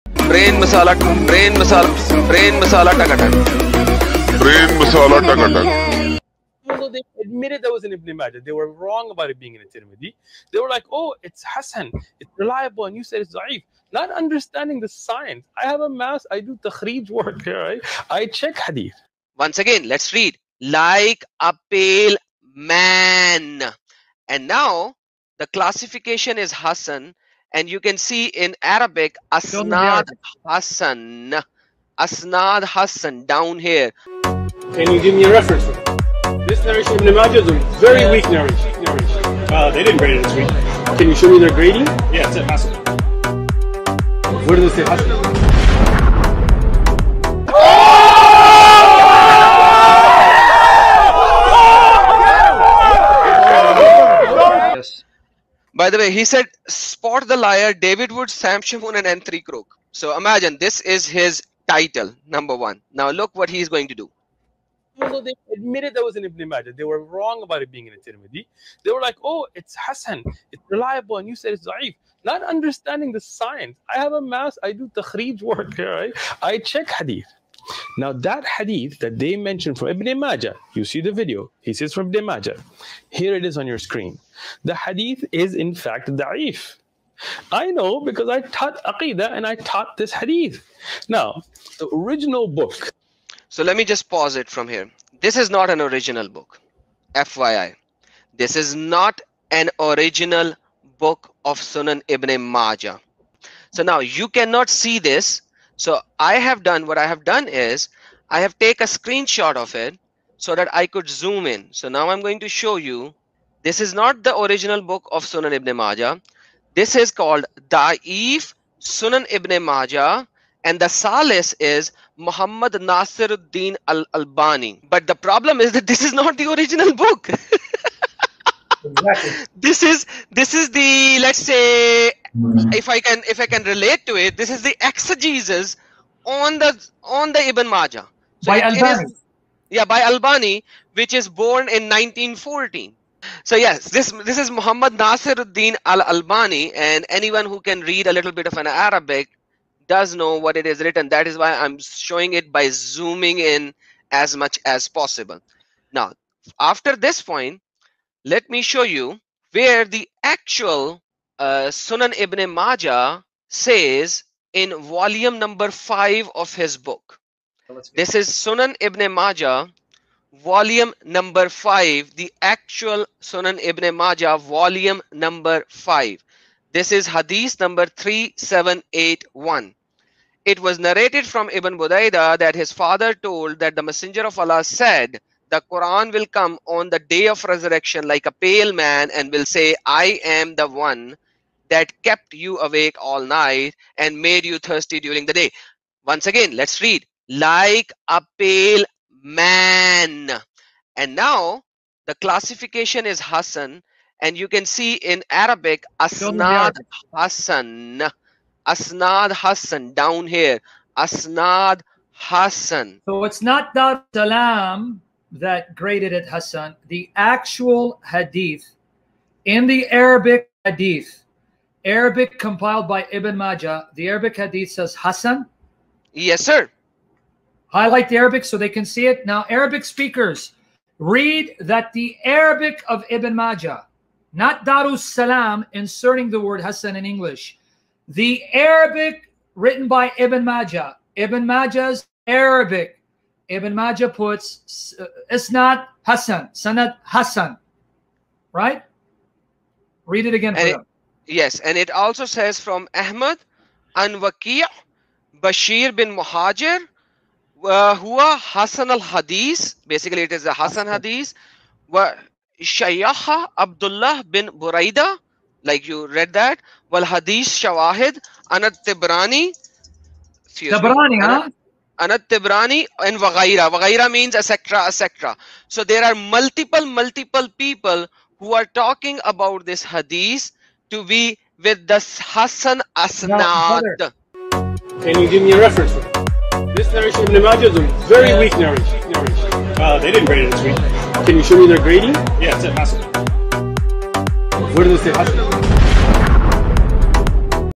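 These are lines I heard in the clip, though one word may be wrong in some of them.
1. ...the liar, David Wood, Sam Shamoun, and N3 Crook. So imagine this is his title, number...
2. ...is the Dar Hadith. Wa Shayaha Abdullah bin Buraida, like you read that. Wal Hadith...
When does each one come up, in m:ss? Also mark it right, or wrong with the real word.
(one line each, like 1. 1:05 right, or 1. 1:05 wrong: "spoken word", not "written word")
1. 0:57 right
2. 4:20 wrong: "Hasan", not "Dar".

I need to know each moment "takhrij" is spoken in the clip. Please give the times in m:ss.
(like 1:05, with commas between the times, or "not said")
0:16, 1:14.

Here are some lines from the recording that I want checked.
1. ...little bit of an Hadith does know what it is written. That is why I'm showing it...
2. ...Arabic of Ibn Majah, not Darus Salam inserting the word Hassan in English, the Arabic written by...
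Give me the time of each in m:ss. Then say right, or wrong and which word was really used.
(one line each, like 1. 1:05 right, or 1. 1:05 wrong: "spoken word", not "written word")
1. 2:28 wrong: "Arabic", not "Hadith"
2. 3:52 right.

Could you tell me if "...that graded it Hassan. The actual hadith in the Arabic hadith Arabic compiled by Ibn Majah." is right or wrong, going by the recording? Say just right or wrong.
right.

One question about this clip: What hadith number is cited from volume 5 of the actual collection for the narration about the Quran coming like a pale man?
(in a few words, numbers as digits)
3781.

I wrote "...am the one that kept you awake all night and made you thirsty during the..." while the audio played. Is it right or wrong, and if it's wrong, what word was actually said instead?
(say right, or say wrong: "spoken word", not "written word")
right.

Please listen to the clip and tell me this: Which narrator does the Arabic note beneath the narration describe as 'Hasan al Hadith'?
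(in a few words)
Bashir bin Muhajir.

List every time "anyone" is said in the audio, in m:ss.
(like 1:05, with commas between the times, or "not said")
2:27.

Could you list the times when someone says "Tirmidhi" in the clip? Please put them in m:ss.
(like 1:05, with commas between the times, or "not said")
0:09, 1:08.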